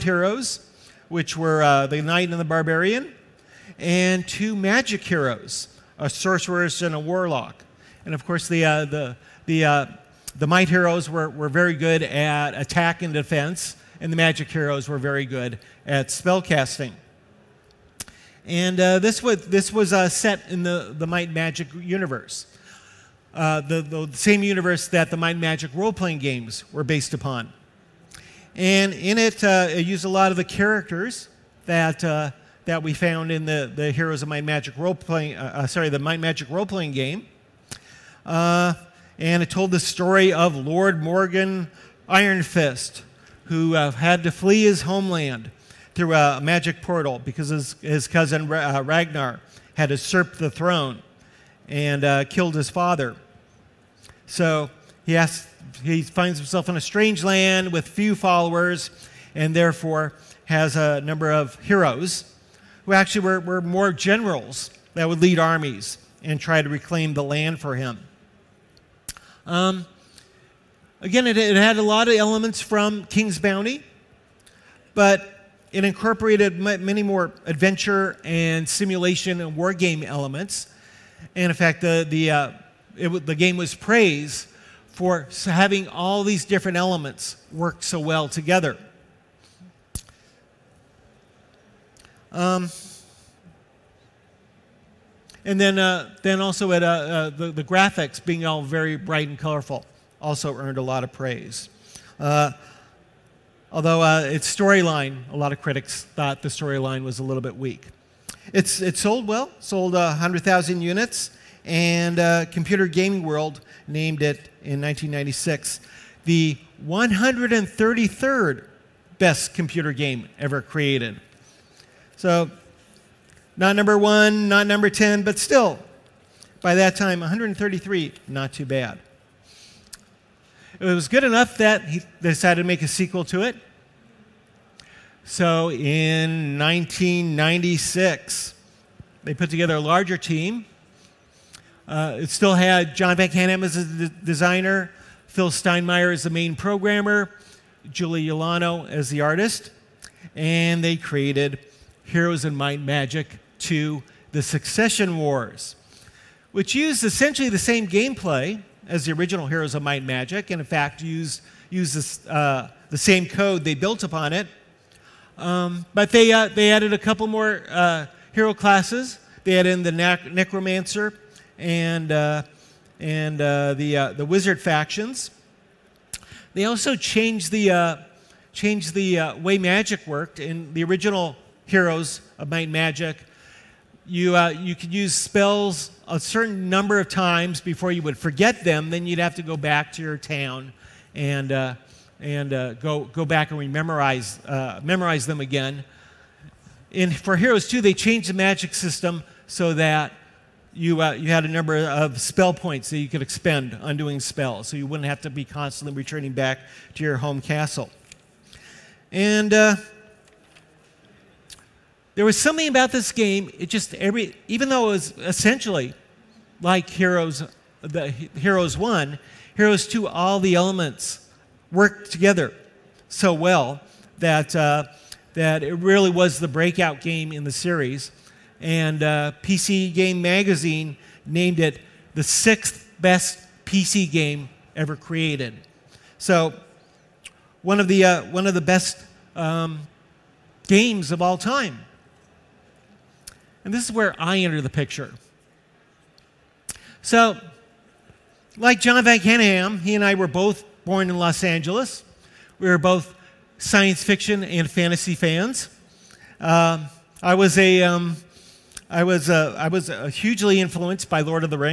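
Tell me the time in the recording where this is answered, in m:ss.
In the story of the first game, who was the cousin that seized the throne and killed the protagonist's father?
0:48.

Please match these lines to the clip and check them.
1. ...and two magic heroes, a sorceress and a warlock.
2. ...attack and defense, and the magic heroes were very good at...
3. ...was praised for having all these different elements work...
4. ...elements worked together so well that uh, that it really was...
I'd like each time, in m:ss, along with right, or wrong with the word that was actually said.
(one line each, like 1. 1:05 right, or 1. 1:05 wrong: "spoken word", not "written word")
1. 0:03 right
2. 0:12 right
3. 1:23 right
4. 3:40 right.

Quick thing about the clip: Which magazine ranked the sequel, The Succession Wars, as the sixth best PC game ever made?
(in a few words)
PC Game Magazine.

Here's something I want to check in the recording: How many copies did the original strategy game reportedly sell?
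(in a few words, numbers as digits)
100,000.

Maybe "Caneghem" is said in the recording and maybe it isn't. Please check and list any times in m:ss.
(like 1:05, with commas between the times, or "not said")
2:23, 4:09.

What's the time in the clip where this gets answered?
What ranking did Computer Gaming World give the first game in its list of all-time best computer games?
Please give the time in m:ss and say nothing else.
1:56.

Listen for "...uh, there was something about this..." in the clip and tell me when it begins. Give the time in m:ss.
3:29.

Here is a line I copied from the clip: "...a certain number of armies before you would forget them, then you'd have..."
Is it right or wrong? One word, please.
wrong.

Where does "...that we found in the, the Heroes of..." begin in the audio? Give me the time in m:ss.
0:32.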